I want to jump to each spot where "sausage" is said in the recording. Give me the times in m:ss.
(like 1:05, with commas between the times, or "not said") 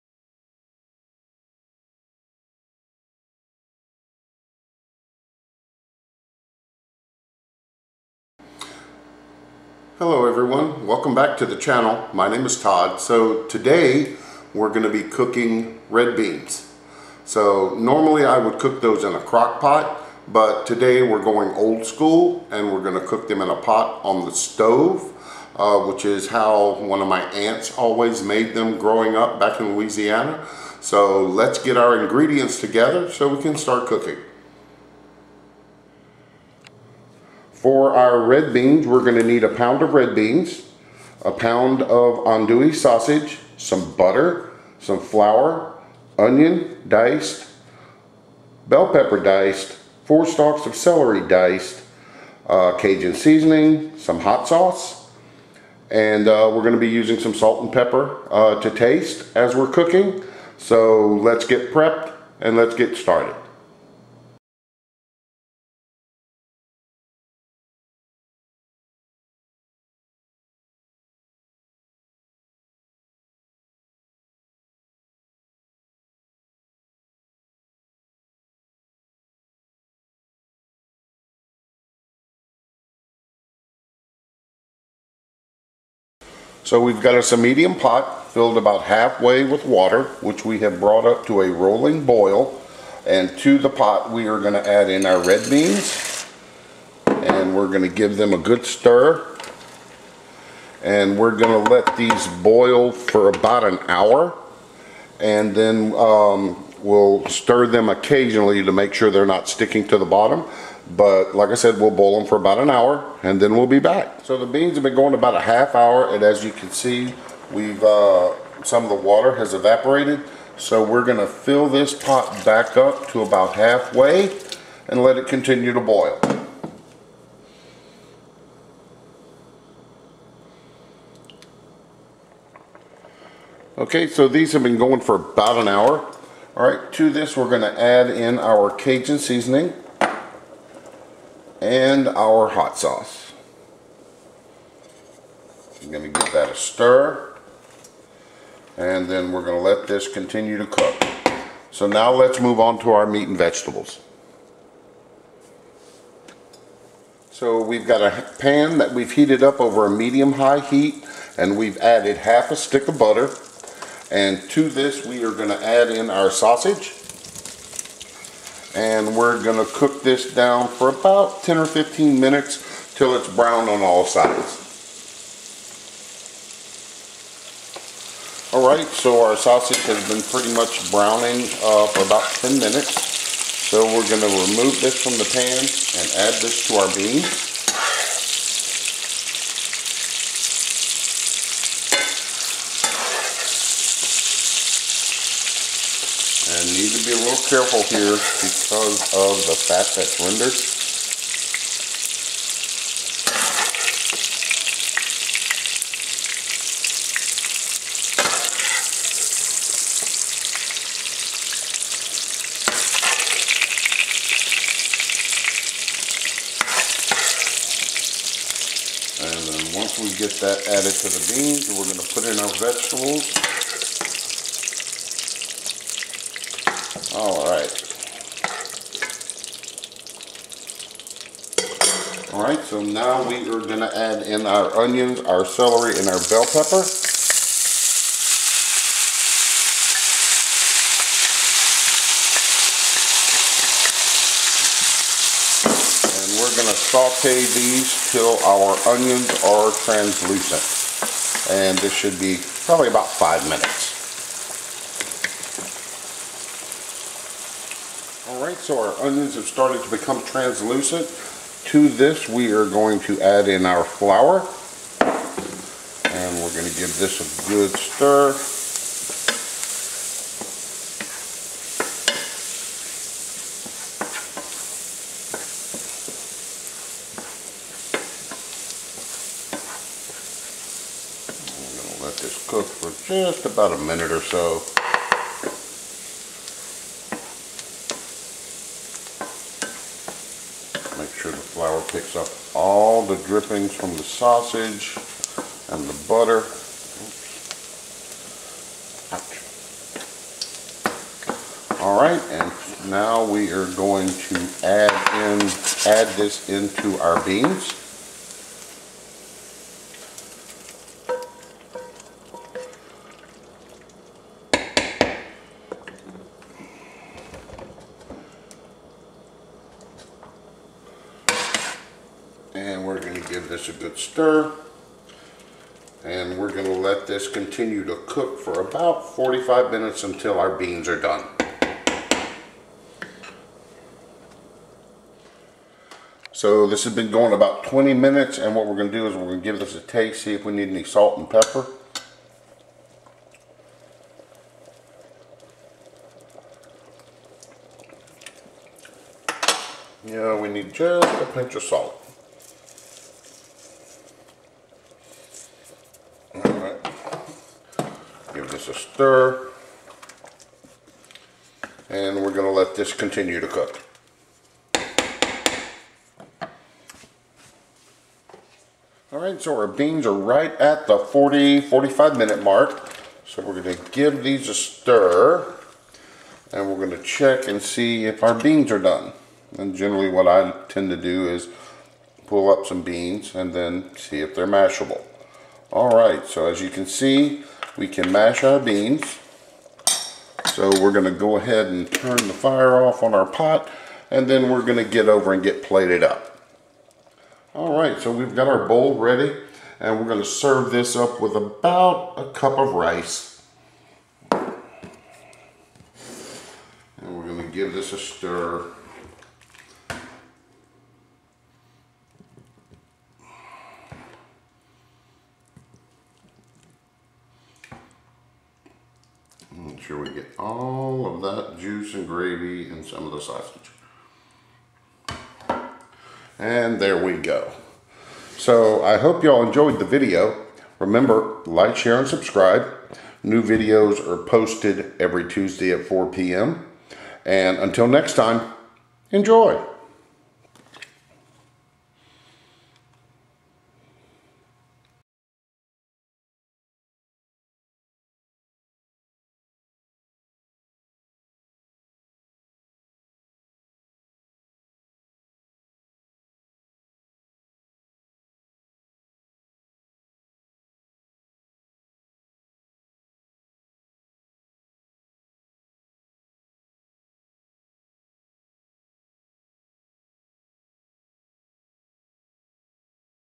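0:42, 2:46, 2:59, 4:54, 7:03.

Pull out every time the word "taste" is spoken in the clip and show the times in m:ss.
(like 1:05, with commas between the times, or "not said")
0:58, 5:39.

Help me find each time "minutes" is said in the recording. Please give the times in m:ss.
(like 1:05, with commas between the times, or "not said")
2:52, 3:02, 4:13, 4:43, 5:29, 5:37, 6:12.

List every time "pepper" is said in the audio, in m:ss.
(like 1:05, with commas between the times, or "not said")
0:48, 0:57, 3:56, 5:41.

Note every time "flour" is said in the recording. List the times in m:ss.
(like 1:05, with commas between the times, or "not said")
0:44, 4:23.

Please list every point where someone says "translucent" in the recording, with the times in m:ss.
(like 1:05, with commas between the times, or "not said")
4:09, 4:20.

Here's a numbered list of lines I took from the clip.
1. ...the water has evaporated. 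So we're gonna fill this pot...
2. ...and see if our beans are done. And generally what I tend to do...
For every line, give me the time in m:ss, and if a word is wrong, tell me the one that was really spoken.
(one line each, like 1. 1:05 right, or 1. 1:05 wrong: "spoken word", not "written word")
1. 1:58 right
2. 6:17 right.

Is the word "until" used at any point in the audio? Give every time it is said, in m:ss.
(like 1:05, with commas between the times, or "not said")
5:30, 7:17.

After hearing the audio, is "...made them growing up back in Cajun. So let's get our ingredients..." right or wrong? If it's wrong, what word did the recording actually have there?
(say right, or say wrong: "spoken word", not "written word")
wrong: "Louisiana", not "Cajun".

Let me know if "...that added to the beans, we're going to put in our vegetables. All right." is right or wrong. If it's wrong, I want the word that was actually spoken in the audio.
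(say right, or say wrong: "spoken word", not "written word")
right.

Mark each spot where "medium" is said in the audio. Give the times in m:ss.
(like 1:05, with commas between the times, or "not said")
1:27, 2:39.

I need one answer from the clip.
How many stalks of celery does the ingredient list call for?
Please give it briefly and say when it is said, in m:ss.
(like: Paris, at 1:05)
4, at 0:50.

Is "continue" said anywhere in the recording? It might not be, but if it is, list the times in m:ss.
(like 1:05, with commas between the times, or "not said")
2:05, 2:30, 5:27, 6:02.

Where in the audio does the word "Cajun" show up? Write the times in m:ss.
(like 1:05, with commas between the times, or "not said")
0:52, 2:18.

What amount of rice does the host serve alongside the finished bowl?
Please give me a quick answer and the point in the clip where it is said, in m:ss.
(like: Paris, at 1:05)
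about a cup, at 6:41.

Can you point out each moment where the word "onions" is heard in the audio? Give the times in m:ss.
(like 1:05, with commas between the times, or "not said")
0:46, 3:54, 4:08, 4:19.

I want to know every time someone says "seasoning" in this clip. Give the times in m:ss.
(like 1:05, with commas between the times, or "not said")
0:53, 2:19.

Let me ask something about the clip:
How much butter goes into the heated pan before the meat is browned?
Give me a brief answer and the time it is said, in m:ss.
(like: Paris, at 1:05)
half a stick, at 2:42.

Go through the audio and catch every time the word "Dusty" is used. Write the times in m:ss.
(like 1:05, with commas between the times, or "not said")
not said.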